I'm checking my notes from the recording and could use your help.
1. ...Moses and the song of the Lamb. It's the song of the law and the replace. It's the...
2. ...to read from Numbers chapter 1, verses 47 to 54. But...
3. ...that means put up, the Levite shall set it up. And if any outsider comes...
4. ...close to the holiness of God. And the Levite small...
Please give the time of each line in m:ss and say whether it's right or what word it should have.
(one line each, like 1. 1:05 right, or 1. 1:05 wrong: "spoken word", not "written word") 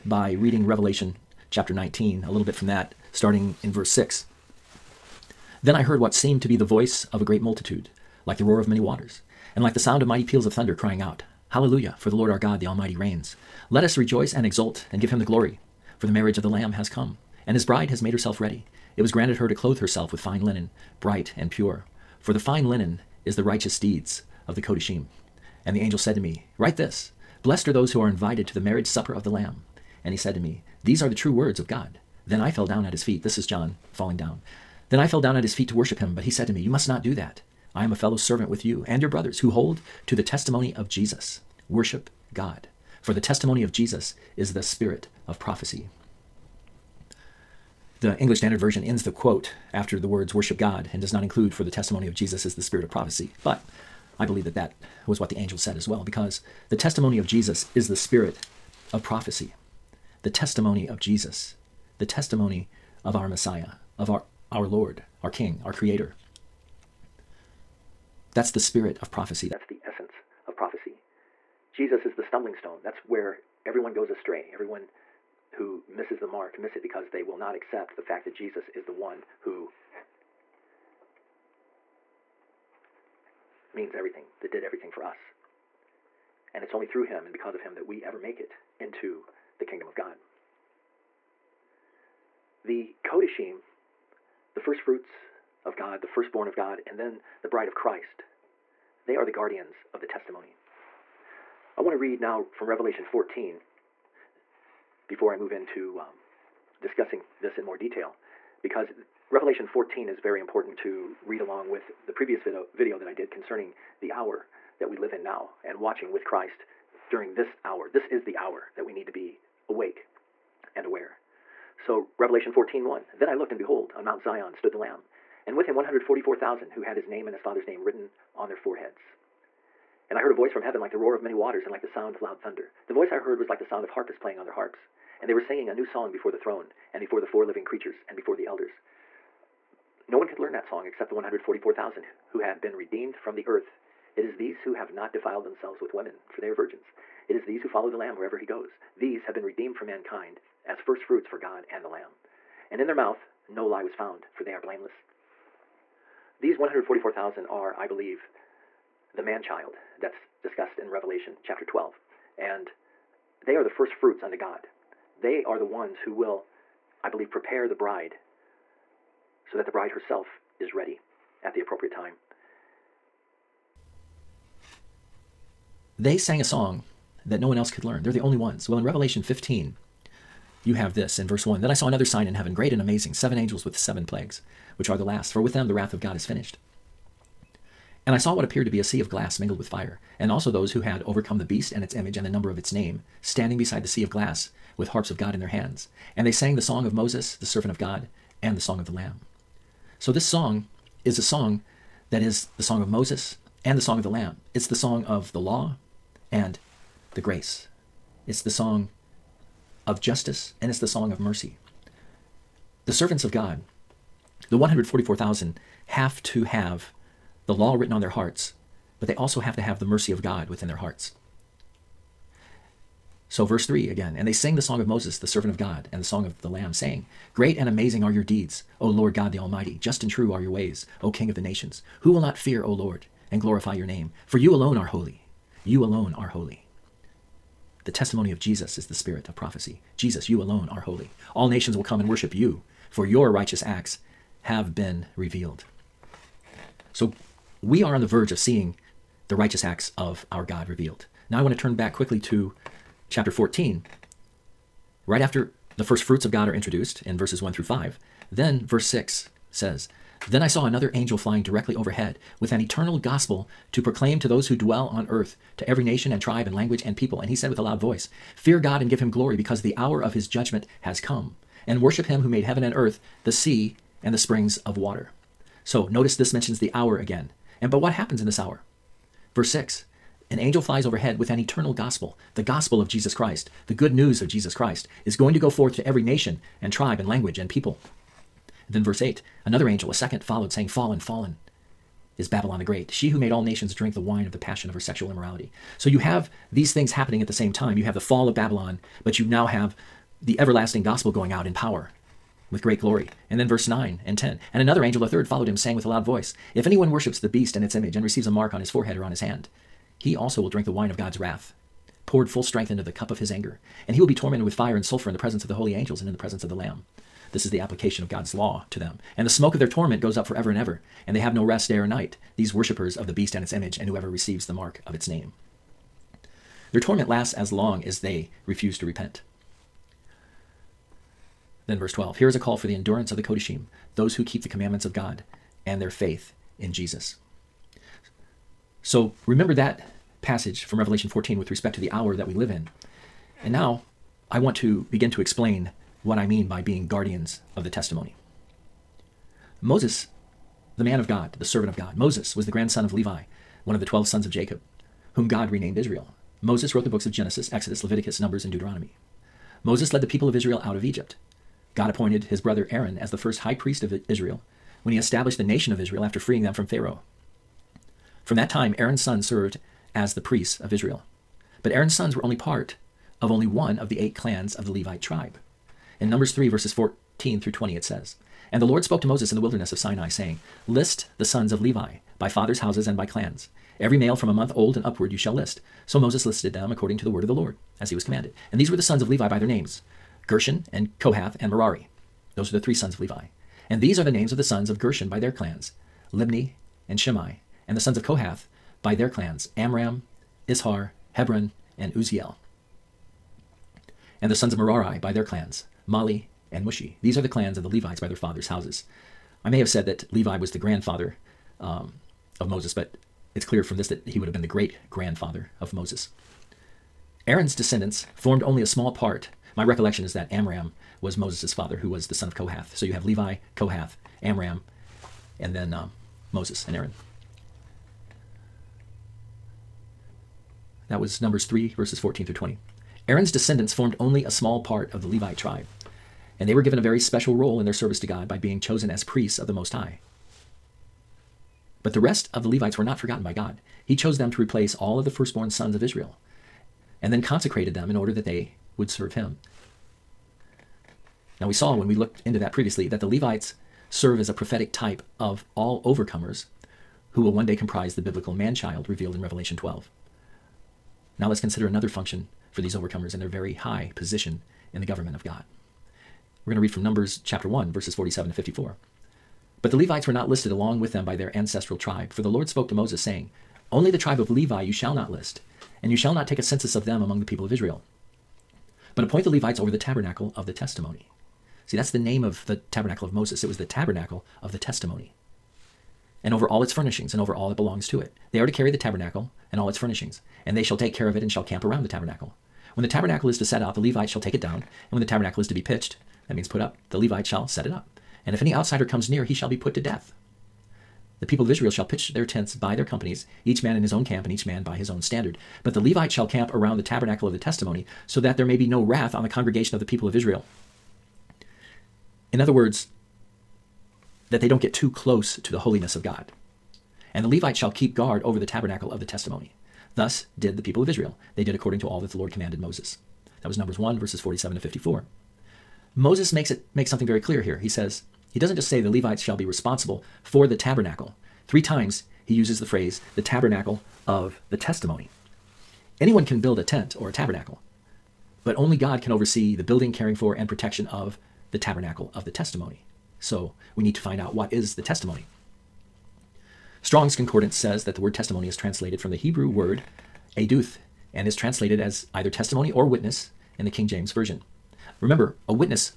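1. 3:22 wrong: "grace", not "replace"
2. 7:46 right
3. 8:16 right
4. 8:34 wrong: "shall", not "small".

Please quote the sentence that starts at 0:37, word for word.
I am a fellow servant with you and your brothers who hold to the testimony of Jesus.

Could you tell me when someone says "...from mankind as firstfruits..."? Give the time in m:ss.
2:29.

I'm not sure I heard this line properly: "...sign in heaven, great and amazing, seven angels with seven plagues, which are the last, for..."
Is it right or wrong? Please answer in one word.
right.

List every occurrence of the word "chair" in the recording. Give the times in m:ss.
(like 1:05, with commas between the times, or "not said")
not said.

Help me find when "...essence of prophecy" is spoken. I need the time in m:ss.
1:09.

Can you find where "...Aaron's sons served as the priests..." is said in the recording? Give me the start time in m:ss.
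6:08.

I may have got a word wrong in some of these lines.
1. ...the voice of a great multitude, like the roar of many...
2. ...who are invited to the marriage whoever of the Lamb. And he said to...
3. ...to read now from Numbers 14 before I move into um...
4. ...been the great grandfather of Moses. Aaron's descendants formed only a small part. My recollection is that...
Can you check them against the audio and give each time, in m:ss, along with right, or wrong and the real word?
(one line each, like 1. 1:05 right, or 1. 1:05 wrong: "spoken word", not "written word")
1. 0:06 right
2. 0:27 wrong: "supper", not "whoever"
3. 1:41 wrong: "Revelation", not "Numbers"
4. 6:54 right.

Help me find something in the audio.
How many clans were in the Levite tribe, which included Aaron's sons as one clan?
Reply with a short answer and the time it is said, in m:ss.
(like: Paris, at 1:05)
8, at 6:13.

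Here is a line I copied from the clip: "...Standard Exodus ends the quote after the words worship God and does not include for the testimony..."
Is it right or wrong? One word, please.
wrong.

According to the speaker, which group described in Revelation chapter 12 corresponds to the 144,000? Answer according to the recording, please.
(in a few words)
the man child.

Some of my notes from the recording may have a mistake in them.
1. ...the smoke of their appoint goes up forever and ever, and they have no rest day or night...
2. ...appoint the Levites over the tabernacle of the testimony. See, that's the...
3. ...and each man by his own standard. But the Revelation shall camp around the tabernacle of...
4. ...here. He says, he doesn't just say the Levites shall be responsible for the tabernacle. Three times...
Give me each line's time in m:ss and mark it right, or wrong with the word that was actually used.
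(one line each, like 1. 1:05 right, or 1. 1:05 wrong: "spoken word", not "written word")
1. 5:19 wrong: "torment", not "appoint"
2. 7:59 right
3. 8:24 wrong: "Levite", not "Revelation"
4. 8:47 right.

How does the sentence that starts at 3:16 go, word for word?
And they sang the song of Moses, the servant of God, and the song of the Lamb.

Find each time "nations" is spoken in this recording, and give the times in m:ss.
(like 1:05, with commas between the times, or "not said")
3:51, 4:01, 4:25, 4:46, 4:53, 6:05.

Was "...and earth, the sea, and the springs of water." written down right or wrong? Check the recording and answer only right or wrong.
right.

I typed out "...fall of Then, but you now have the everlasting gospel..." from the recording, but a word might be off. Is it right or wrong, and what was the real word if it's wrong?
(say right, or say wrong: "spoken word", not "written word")
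wrong: "Babylon", not "Then".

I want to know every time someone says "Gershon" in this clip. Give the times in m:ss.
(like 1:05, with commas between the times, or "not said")
6:30, 6:34.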